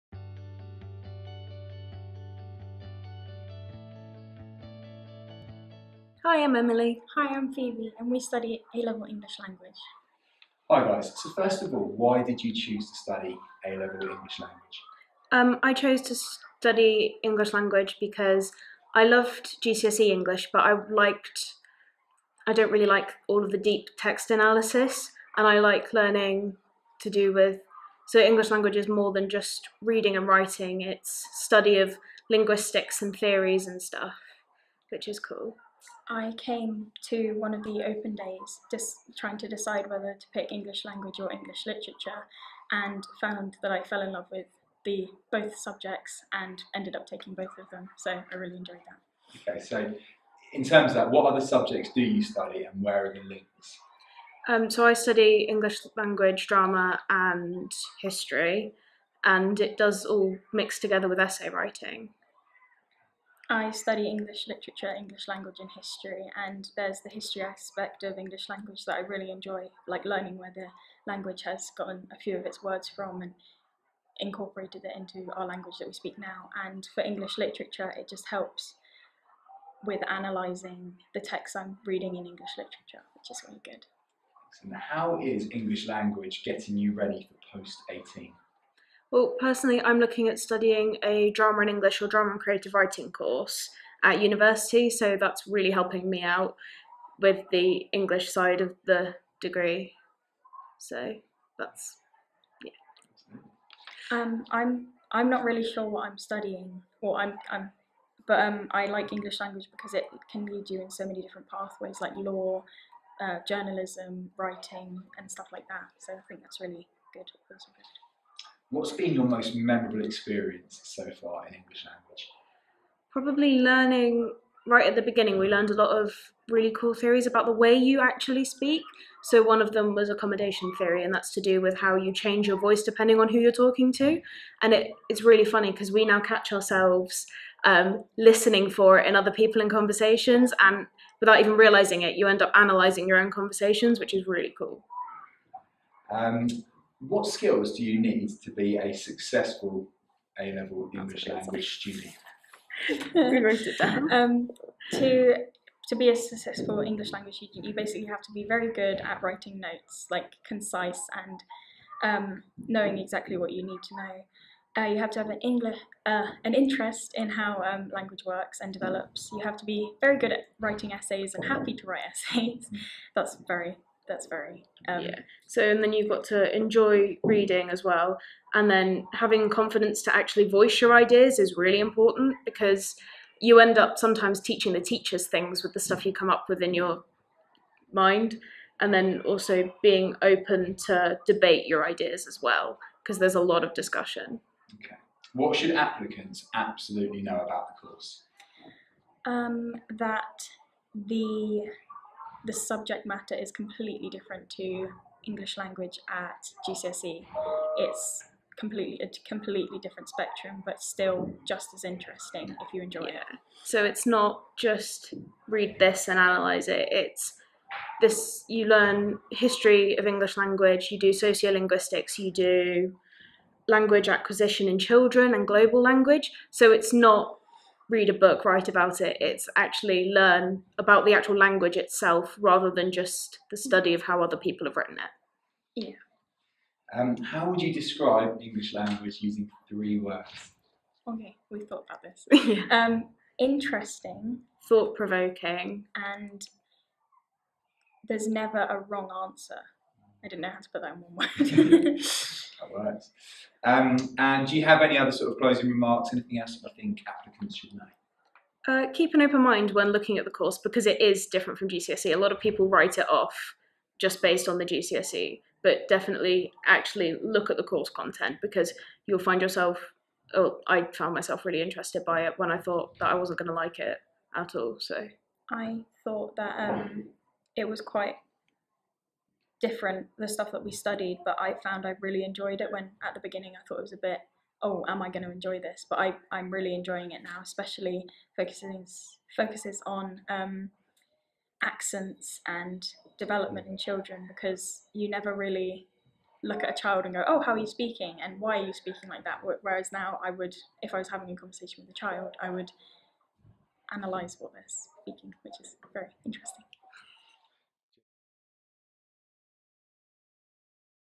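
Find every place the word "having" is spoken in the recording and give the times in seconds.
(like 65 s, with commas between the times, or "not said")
179 s, 301 s.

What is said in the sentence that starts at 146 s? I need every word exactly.
Um, what skills do you need to be a successful A level English language student?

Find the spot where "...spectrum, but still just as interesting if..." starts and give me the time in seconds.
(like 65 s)
210 s.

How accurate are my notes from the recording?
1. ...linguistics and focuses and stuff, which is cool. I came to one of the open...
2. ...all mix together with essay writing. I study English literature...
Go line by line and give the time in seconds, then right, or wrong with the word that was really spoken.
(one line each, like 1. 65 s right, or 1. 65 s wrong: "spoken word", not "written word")
1. 32 s wrong: "theories", not "focuses"
2. 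60 s right.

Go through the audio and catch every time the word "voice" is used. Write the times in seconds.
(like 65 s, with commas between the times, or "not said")
132 s, 180 s.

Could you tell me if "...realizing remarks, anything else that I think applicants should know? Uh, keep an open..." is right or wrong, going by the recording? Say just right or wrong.
wrong.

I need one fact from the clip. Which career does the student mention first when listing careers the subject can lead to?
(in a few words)
law.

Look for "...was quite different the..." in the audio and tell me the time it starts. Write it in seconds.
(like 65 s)
277 s.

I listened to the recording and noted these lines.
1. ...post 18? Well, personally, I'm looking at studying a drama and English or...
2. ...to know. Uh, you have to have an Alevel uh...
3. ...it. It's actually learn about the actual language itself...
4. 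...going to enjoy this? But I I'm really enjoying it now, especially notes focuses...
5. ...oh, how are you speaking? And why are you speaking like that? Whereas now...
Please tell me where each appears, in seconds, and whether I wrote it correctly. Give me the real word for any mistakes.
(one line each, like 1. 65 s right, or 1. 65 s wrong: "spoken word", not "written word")
1. 87 s right
2. 163 s wrong: "English", not "Alevel"
3. 229 s right
4. 285 s wrong: "focuses", not "notes"
5. 297 s right.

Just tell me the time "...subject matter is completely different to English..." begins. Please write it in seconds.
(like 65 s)
202 s.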